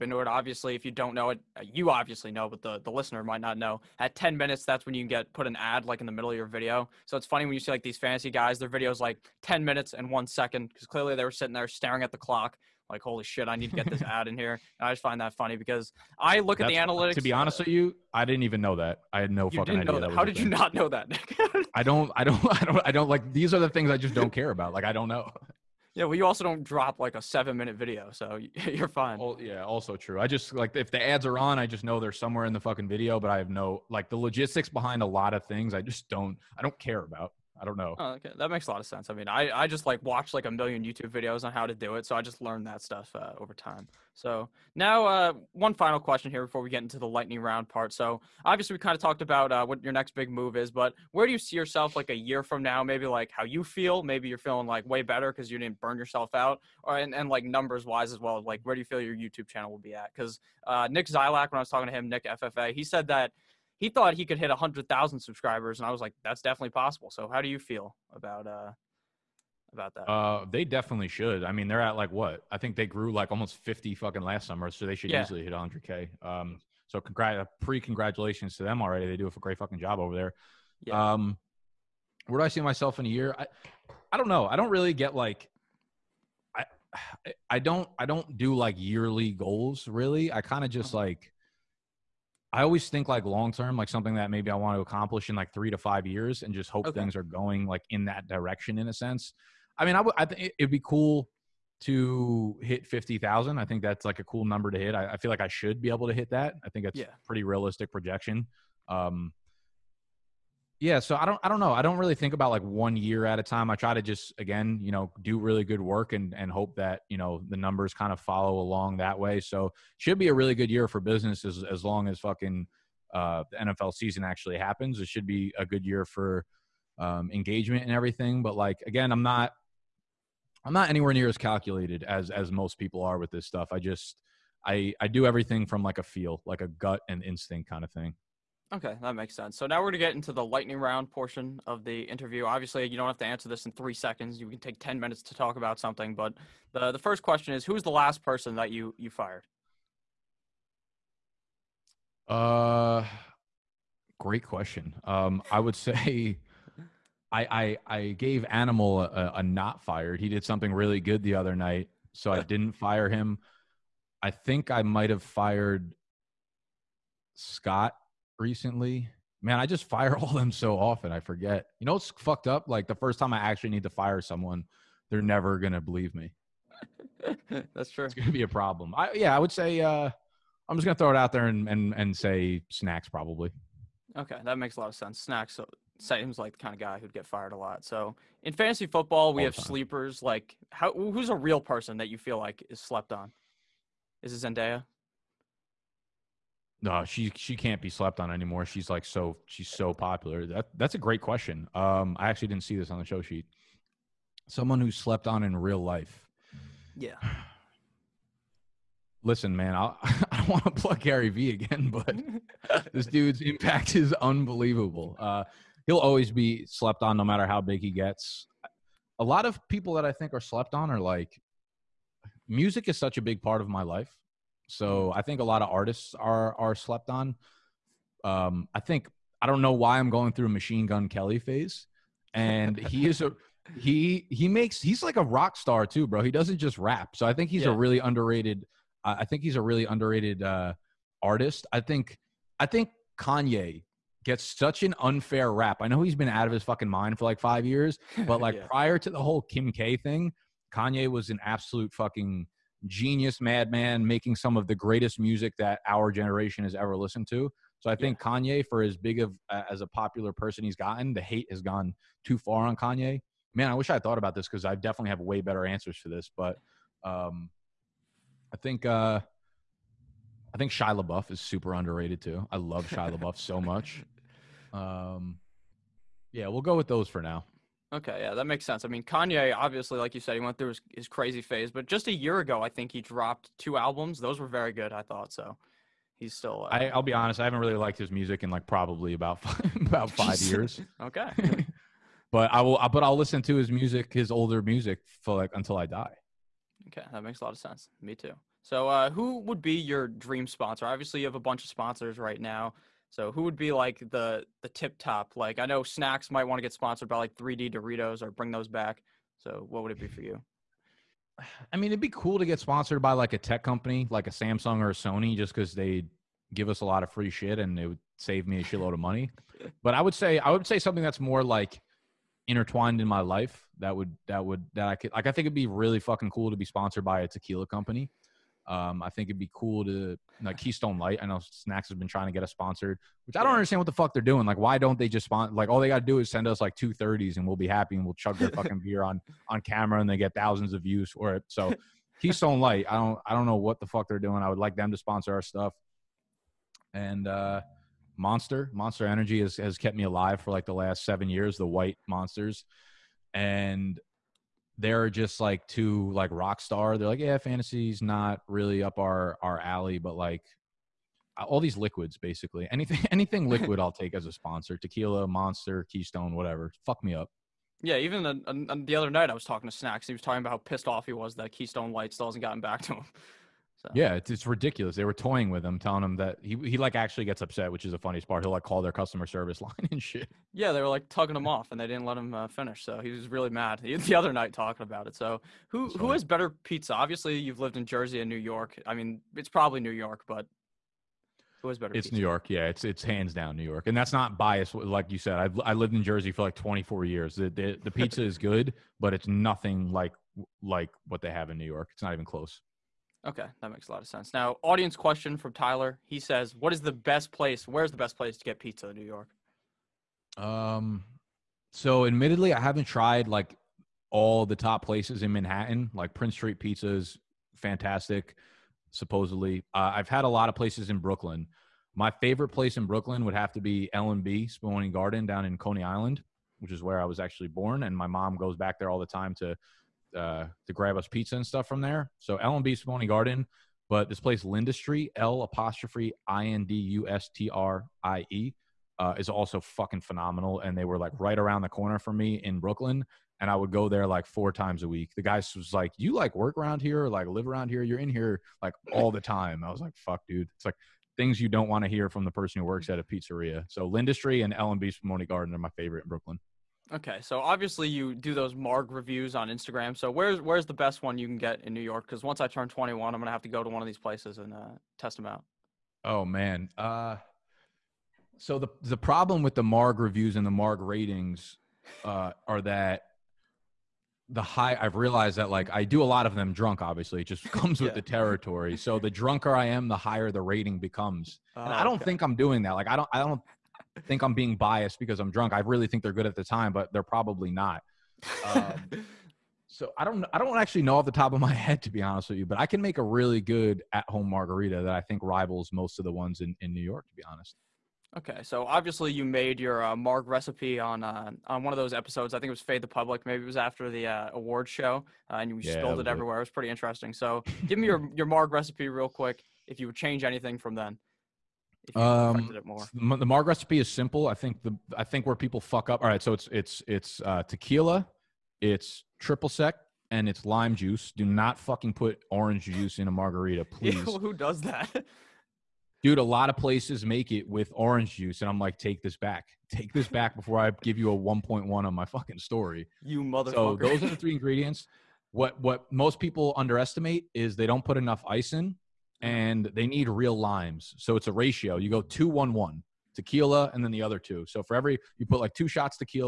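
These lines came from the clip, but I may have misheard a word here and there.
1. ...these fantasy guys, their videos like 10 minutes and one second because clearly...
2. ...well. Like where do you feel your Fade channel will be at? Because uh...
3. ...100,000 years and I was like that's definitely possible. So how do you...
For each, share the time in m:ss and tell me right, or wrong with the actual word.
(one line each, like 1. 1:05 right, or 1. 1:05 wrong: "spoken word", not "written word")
1. 0:07 right
2. 0:58 wrong: "YouTube", not "Fade"
3. 1:04 wrong: "subscribers", not "years".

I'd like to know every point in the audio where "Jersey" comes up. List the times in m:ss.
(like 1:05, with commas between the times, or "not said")
6:27, 6:36.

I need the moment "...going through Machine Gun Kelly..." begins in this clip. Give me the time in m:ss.
3:50.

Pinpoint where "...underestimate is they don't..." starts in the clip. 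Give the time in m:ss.
8:56.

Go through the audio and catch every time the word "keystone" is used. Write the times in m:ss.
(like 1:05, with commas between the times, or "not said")
5:30, 5:42, 6:05, 6:11.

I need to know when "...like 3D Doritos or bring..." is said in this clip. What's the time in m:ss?
5:07.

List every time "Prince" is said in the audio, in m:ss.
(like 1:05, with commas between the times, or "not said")
6:56.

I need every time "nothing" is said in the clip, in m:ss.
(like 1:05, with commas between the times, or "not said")
6:39.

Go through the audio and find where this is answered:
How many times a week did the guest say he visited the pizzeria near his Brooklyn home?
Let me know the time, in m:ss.
7:24.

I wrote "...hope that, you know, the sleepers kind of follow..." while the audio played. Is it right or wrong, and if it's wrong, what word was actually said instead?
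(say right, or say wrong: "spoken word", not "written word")
wrong: "numbers", not "sleepers".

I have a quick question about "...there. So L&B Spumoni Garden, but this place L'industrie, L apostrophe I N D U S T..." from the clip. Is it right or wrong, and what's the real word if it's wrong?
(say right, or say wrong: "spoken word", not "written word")
right.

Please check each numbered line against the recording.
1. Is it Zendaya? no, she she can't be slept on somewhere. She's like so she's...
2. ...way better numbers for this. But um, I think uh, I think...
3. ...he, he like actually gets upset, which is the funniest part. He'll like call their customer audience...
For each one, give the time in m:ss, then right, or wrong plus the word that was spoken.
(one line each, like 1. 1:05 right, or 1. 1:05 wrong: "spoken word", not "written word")
1. 3:14 wrong: "anymore", not "somewhere"
2. 4:25 wrong: "answers", not "numbers"
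3. 6:16 wrong: "service", not "audience".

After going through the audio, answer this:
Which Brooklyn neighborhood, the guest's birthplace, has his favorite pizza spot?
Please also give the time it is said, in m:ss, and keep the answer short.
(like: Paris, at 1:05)
Coney Island, at 7:05.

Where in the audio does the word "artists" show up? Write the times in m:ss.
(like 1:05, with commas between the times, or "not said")
3:45, 4:01.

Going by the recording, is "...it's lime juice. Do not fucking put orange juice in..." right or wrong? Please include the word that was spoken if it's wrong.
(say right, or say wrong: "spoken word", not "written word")
right.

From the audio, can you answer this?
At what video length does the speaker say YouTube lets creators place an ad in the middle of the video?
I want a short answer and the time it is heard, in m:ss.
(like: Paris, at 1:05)
10 minutes, at 0:03.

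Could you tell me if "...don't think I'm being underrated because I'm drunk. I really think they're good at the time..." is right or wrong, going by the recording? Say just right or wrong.
wrong.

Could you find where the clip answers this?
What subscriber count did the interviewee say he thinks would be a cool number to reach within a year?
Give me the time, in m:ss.
1:42.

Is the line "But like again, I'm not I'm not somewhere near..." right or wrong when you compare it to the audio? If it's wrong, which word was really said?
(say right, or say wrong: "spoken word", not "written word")
wrong: "anywhere", not "somewhere".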